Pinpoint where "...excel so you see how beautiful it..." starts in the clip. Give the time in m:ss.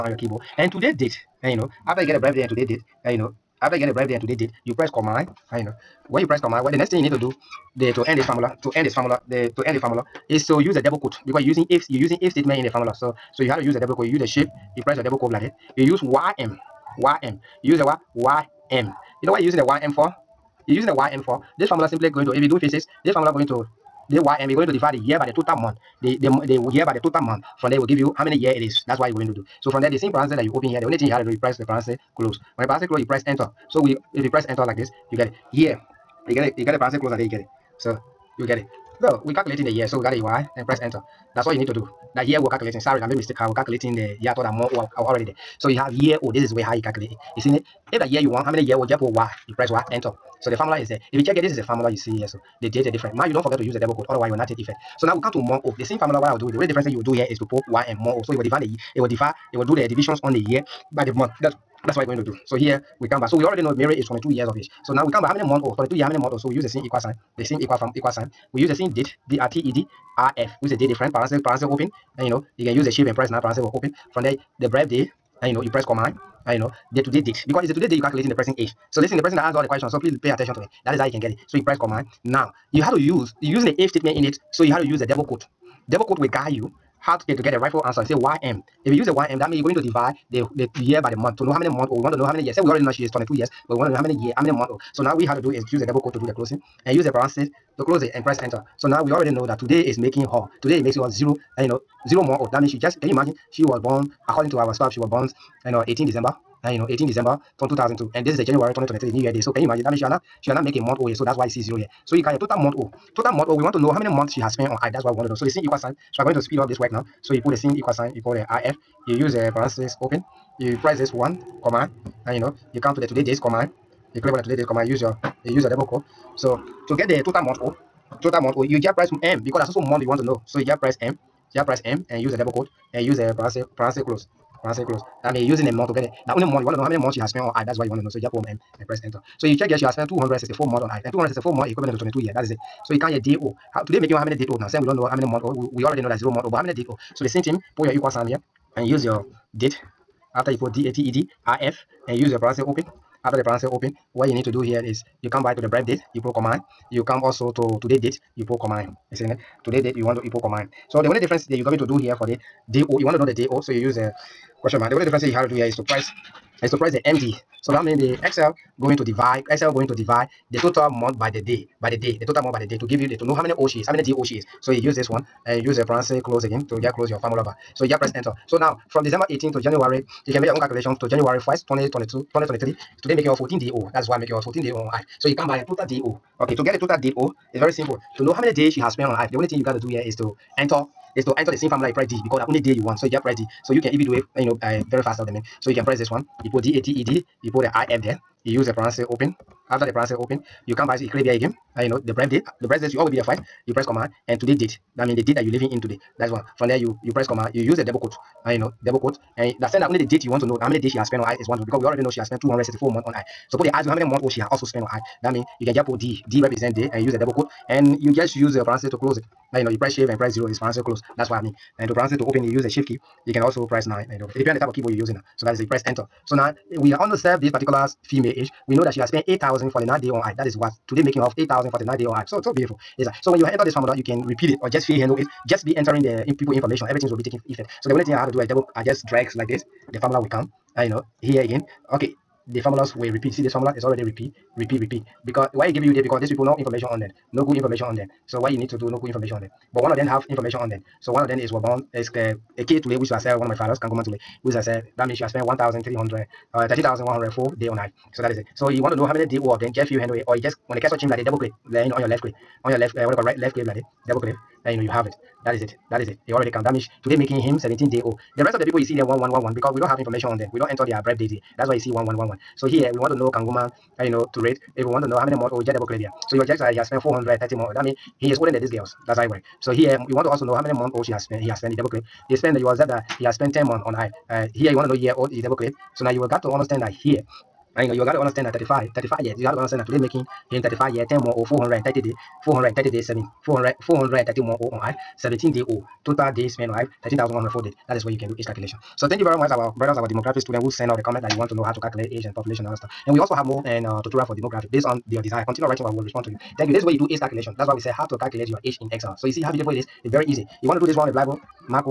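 5:08.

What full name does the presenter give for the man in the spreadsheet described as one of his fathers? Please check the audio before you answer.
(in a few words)
Kangoma Tule.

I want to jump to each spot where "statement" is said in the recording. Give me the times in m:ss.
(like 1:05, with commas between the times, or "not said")
0:12, 1:23.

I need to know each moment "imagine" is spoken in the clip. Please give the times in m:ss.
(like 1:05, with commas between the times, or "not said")
1:43, 1:49.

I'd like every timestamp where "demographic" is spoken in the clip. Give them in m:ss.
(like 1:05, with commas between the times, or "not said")
5:00, 5:04.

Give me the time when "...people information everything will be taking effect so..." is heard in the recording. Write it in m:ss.
3:56.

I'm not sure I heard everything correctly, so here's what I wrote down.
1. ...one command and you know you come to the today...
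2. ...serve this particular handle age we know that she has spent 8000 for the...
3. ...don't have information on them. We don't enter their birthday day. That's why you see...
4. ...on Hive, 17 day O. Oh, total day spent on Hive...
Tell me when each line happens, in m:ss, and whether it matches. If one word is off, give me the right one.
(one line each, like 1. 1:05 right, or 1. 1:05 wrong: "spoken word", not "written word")
1. 2:01 right
2. 3:47 wrong: "female", not "handle"
3. 4:29 right
4. 4:54 right.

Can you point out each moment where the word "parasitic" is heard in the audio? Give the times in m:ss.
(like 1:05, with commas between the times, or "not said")
0:32, 0:36.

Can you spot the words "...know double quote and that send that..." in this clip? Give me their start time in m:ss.
3:28.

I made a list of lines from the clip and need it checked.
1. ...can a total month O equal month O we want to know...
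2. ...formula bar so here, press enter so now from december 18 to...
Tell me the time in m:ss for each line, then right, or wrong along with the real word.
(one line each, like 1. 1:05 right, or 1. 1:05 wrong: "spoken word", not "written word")
1. 1:52 wrong: "total", not "equal"
2. 2:57 right.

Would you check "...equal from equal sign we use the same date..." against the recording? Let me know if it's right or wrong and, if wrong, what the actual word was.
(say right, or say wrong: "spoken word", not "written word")
right.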